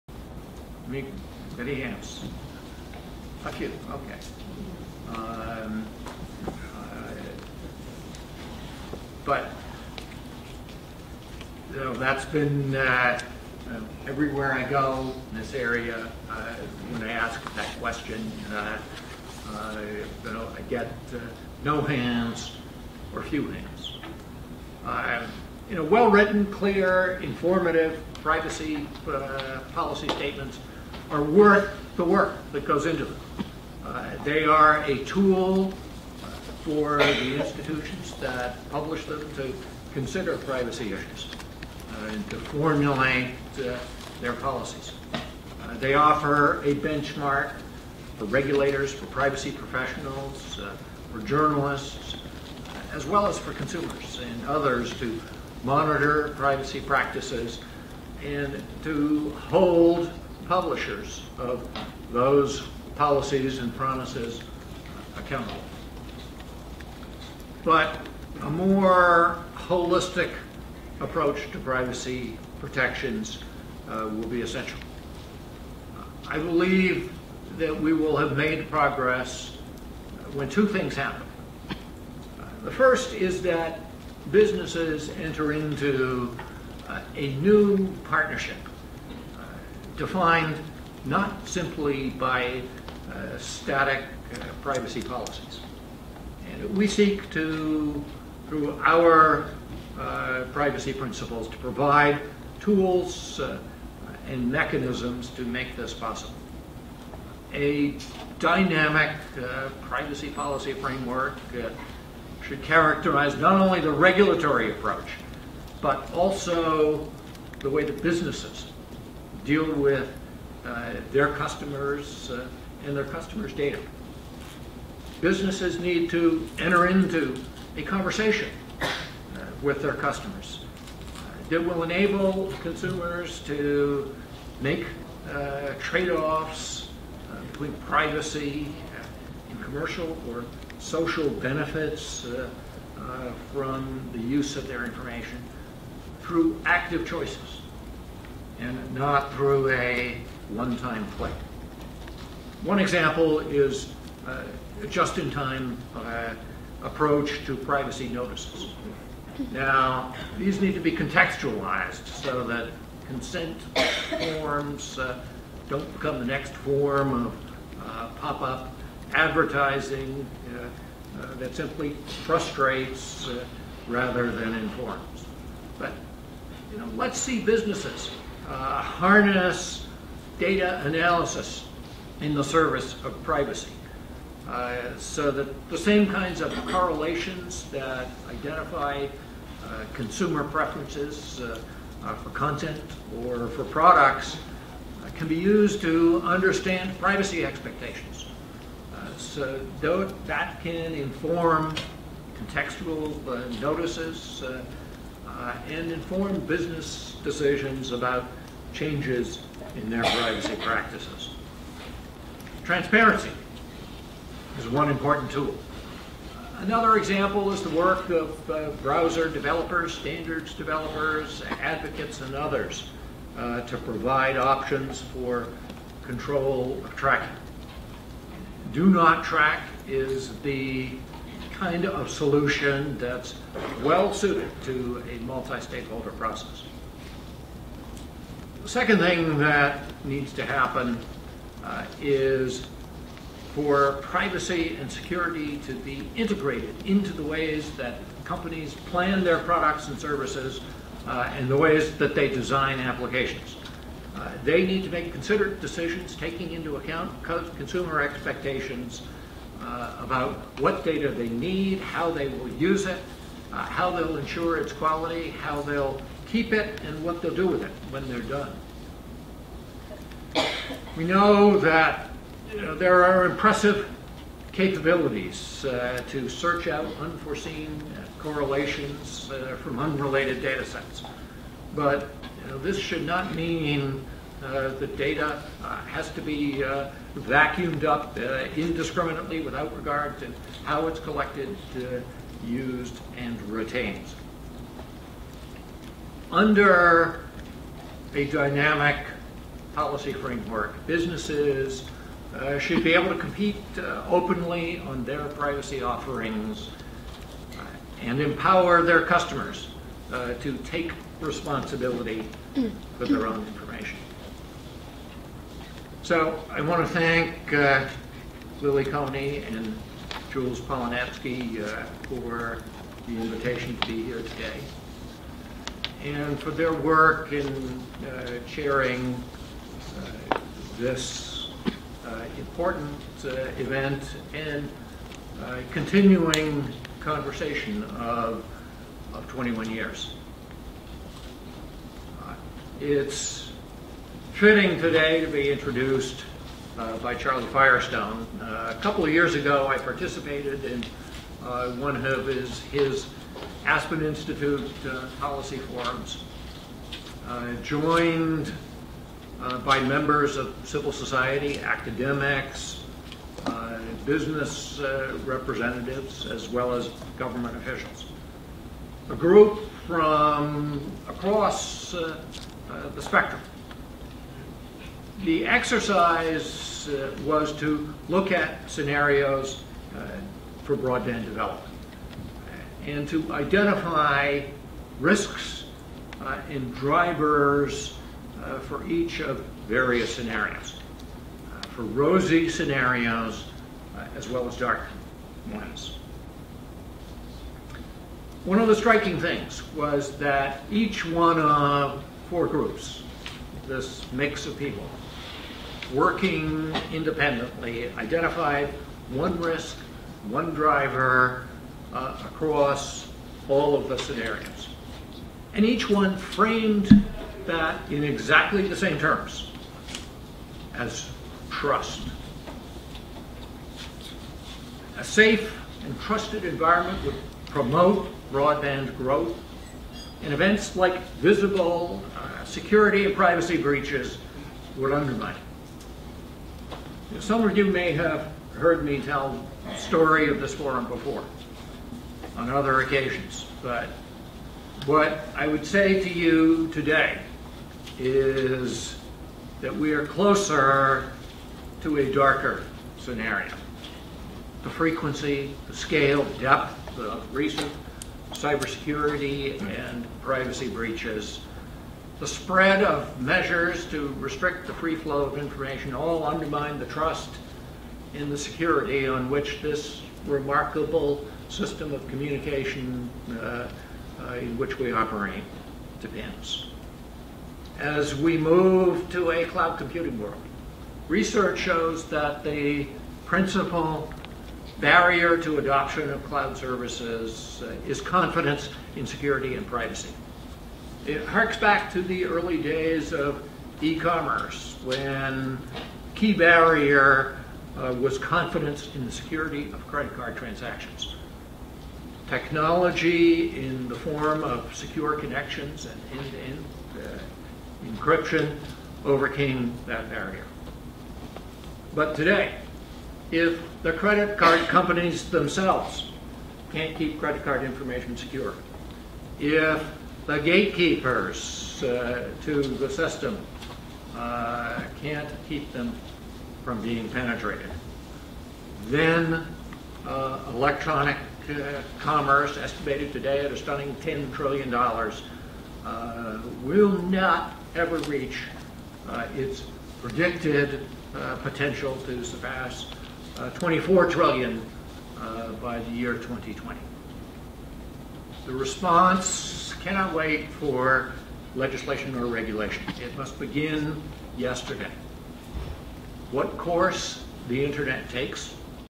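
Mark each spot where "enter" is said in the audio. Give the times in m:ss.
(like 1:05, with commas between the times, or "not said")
1:25, 2:06.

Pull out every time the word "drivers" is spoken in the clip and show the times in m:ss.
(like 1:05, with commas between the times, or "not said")
6:26, 6:50.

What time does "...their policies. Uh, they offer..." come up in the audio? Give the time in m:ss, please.
0:44.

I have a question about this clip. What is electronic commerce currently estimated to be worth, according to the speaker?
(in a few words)
$10 trillion.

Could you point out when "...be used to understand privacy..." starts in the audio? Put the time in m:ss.
3:15.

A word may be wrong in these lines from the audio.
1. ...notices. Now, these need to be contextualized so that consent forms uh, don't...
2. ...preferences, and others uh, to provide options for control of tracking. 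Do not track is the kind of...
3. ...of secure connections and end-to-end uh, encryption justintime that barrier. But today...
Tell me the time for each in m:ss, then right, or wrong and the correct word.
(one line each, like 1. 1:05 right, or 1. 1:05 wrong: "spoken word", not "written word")
1. 2:38 right
2. 3:41 wrong: "advocates", not "preferences"
3. 8:24 wrong: "overcame", not "justintime".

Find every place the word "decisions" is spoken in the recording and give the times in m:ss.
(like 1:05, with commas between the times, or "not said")
3:27, 4:15.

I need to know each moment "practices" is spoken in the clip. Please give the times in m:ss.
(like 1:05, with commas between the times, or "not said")
0:56, 3:30.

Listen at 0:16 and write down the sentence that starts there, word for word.
Uh, when I ask that question, you know, uh, I get uh, no hands or few hands.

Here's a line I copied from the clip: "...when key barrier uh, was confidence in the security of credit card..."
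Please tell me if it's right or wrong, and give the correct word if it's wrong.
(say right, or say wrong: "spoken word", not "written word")
right.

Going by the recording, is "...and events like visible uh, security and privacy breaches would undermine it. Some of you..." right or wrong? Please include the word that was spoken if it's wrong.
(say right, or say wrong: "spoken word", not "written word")
right.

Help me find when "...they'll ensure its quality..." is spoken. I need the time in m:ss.
4:23.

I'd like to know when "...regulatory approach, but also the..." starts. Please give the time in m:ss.
1:53.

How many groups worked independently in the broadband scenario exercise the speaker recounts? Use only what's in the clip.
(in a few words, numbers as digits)
4.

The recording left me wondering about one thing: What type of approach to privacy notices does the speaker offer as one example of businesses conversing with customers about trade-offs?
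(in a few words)
just-in-time.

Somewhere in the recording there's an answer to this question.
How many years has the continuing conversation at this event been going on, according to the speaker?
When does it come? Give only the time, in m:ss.
5:39.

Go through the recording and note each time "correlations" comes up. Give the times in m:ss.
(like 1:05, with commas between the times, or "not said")
3:06, 4:38.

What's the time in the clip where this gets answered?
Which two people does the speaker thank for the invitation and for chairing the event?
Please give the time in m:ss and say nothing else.
5:18.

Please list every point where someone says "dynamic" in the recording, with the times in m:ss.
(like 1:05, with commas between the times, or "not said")
1:48, 4:58.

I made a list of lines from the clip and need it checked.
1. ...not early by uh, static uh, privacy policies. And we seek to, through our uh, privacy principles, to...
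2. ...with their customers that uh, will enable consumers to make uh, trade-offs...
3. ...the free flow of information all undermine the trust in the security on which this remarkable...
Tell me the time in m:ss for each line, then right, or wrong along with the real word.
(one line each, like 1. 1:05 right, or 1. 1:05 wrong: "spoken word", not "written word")
1. 1:31 wrong: "simply", not "early"
2. 2:09 right
3. 7:44 right.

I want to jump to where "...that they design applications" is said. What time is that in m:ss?
4:11.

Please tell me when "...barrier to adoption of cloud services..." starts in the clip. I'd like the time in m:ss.
8:04.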